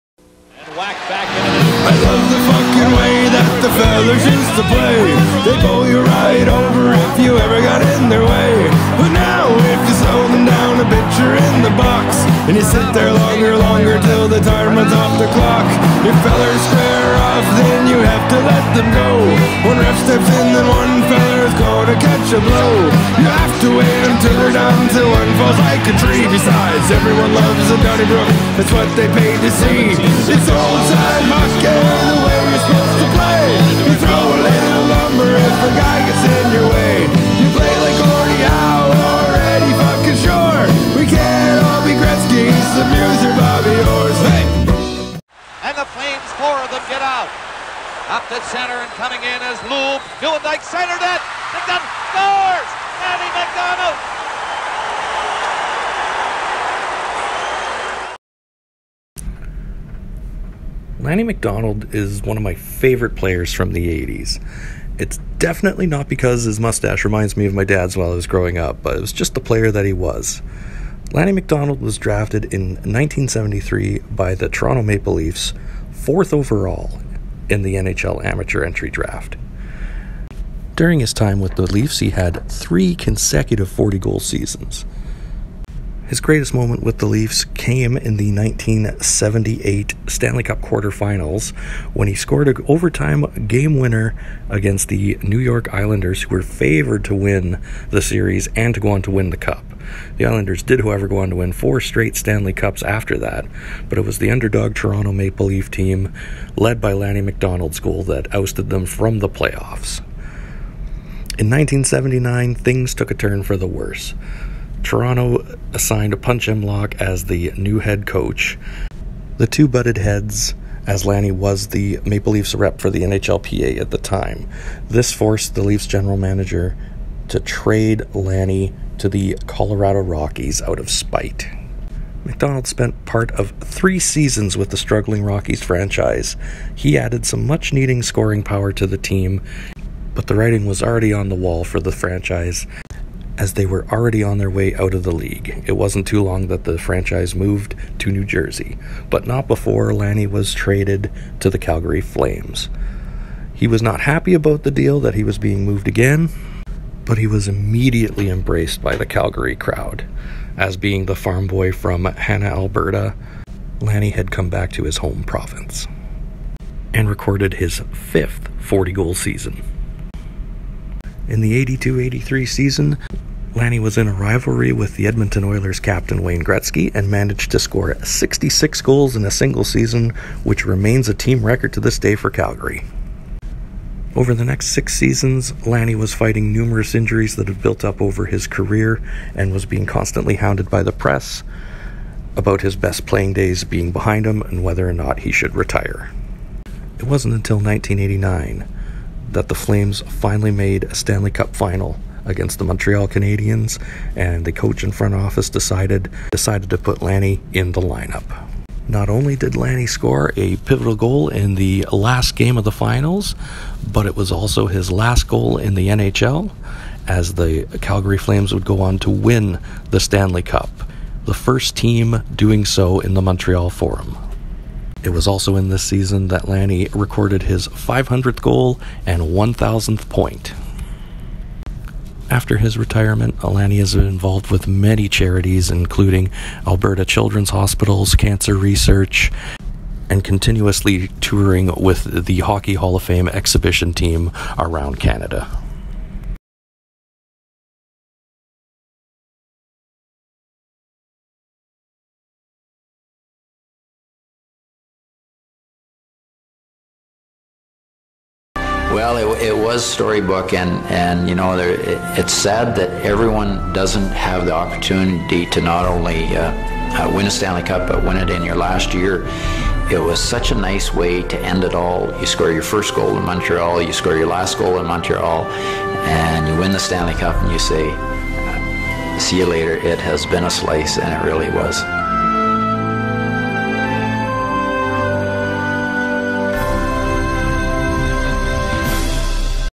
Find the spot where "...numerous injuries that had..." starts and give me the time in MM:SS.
03:06.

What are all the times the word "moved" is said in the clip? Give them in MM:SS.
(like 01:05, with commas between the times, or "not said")
02:27, 02:35.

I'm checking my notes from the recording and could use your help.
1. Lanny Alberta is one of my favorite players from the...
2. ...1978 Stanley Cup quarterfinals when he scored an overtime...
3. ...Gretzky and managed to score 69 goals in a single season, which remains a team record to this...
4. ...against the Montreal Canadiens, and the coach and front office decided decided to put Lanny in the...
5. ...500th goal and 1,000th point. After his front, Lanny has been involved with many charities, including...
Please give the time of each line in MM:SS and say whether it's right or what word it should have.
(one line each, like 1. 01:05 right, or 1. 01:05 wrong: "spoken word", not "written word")
1. 01:00 wrong: "McDonald", not "Alberta"
2. 01:28 right
3. 02:56 wrong: "66", not "69"
4. 03:22 right
5. 03:47 wrong: "retirement", not "front".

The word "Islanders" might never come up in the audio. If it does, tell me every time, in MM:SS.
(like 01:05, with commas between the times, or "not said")
01:35, 01:40.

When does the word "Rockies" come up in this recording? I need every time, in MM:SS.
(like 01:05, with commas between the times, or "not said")
02:10, 02:15.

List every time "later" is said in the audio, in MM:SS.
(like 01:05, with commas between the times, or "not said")
04:39.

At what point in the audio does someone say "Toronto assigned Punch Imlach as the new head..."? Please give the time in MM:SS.
01:54.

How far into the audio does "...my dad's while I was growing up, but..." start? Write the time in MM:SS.
01:07.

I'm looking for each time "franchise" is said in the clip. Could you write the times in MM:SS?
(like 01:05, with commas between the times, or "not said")
02:15, 02:21, 02:26.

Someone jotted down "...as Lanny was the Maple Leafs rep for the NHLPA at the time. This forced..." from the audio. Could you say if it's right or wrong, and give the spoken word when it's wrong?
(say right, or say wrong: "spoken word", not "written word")
right.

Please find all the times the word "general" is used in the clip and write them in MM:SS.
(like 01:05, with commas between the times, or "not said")
02:05.